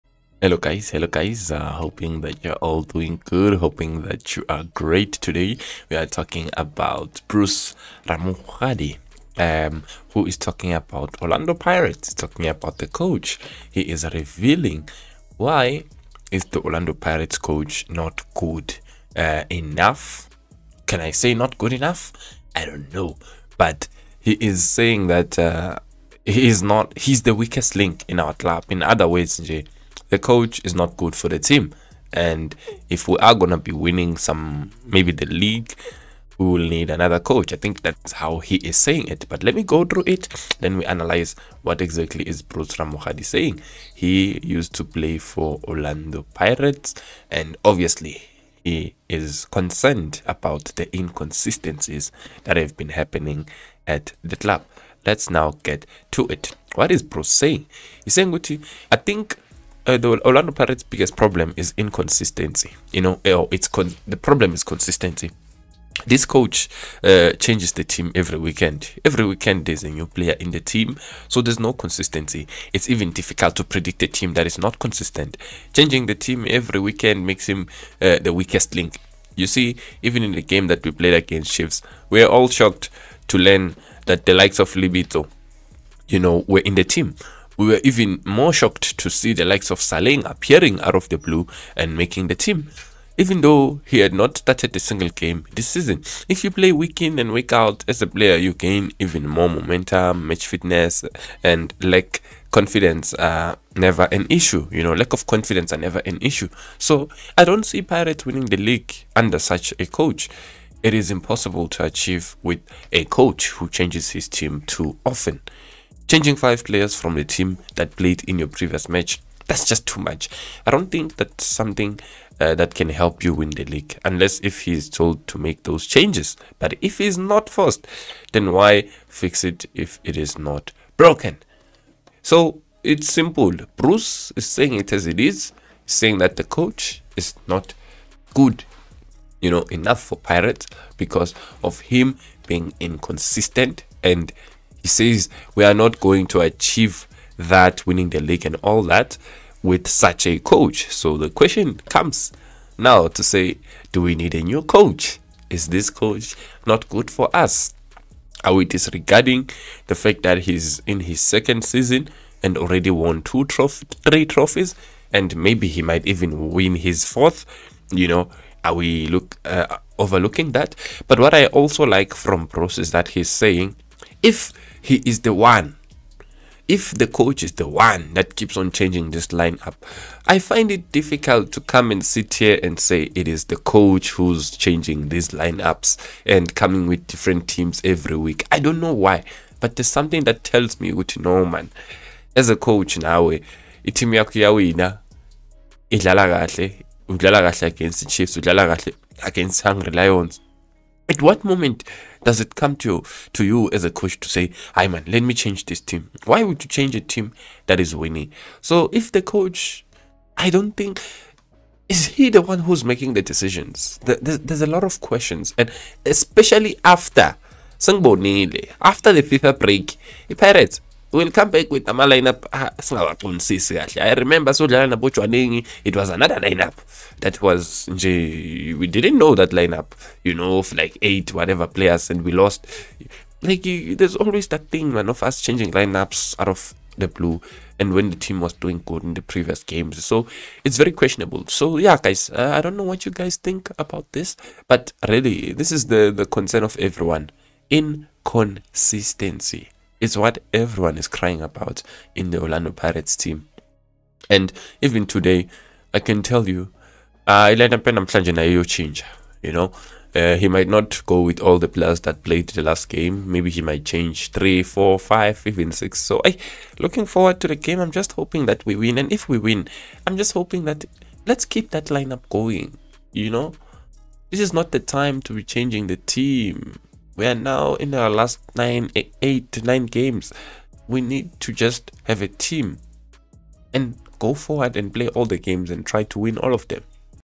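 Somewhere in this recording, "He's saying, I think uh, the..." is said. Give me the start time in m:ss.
0:58.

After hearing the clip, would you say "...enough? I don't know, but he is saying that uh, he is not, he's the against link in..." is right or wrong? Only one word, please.
wrong.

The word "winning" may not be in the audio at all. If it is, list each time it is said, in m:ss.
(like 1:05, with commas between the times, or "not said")
0:33, 1:48, 2:27, 3:27.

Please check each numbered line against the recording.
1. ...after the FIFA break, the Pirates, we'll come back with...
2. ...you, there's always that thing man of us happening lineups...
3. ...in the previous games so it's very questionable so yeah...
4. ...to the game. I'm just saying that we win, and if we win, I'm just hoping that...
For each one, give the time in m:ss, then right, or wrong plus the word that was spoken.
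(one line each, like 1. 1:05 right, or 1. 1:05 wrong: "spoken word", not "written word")
1. 3:37 right
2. 3:53 wrong: "changing", not "happening"
3. 3:59 right
4. 4:27 wrong: "hoping", not "saying".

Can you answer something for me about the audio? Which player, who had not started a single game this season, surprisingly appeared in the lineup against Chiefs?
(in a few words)
Saleng.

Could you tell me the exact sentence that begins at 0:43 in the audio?
He used to play for Orlando Pirates.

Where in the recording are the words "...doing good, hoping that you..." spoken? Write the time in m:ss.
0:02.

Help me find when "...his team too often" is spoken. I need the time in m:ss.
1:54.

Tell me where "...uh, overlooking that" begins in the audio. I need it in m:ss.
2:49.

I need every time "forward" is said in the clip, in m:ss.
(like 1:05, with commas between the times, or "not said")
4:27, 4:44.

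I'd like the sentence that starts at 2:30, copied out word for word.
So the question comes now to say, do we need a new coach?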